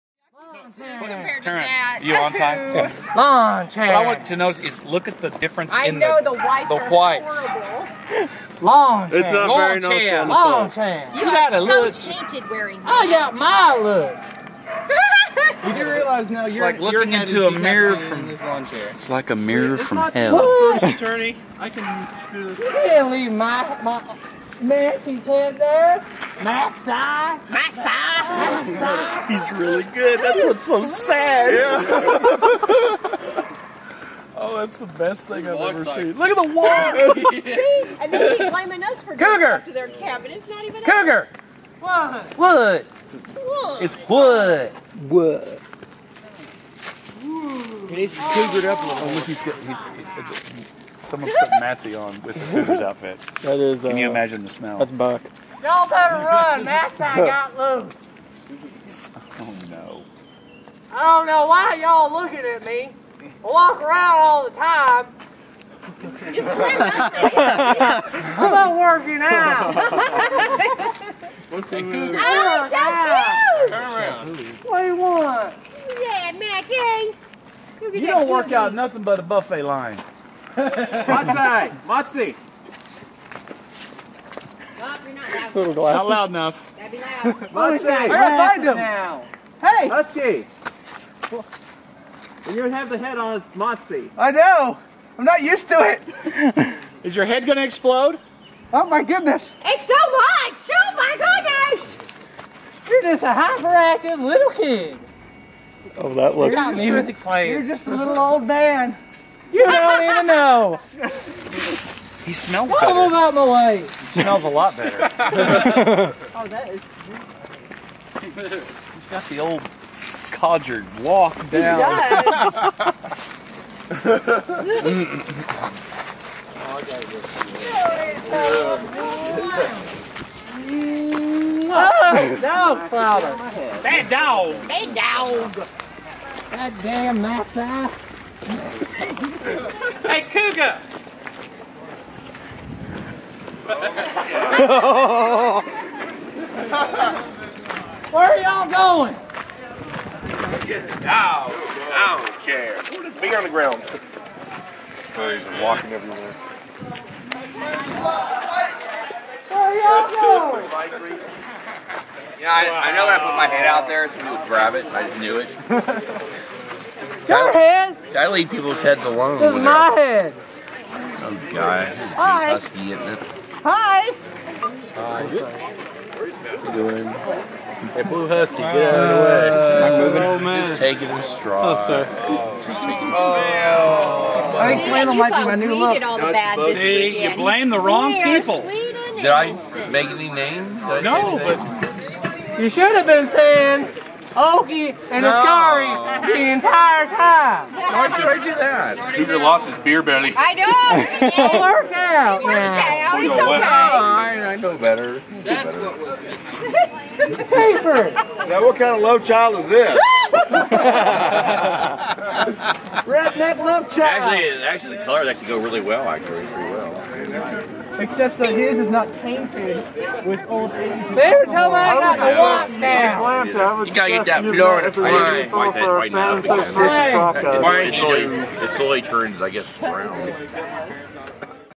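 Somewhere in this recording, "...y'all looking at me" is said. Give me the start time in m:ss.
1:01.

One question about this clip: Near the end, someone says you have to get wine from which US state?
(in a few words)
Florida.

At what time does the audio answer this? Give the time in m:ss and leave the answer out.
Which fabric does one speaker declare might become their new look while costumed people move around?
3:04.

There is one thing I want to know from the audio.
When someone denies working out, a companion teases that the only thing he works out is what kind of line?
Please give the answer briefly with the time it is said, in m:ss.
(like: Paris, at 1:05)
buffet line, at 1:19.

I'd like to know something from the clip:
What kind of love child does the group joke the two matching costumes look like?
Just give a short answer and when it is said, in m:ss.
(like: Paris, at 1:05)
Redneck, at 3:33.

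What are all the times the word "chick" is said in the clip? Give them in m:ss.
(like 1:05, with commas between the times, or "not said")
not said.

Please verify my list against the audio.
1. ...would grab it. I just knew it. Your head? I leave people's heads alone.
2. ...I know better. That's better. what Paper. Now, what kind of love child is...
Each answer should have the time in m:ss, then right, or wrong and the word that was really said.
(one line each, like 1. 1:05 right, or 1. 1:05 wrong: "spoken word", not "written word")
1. 2:44 right
2. 3:24 right.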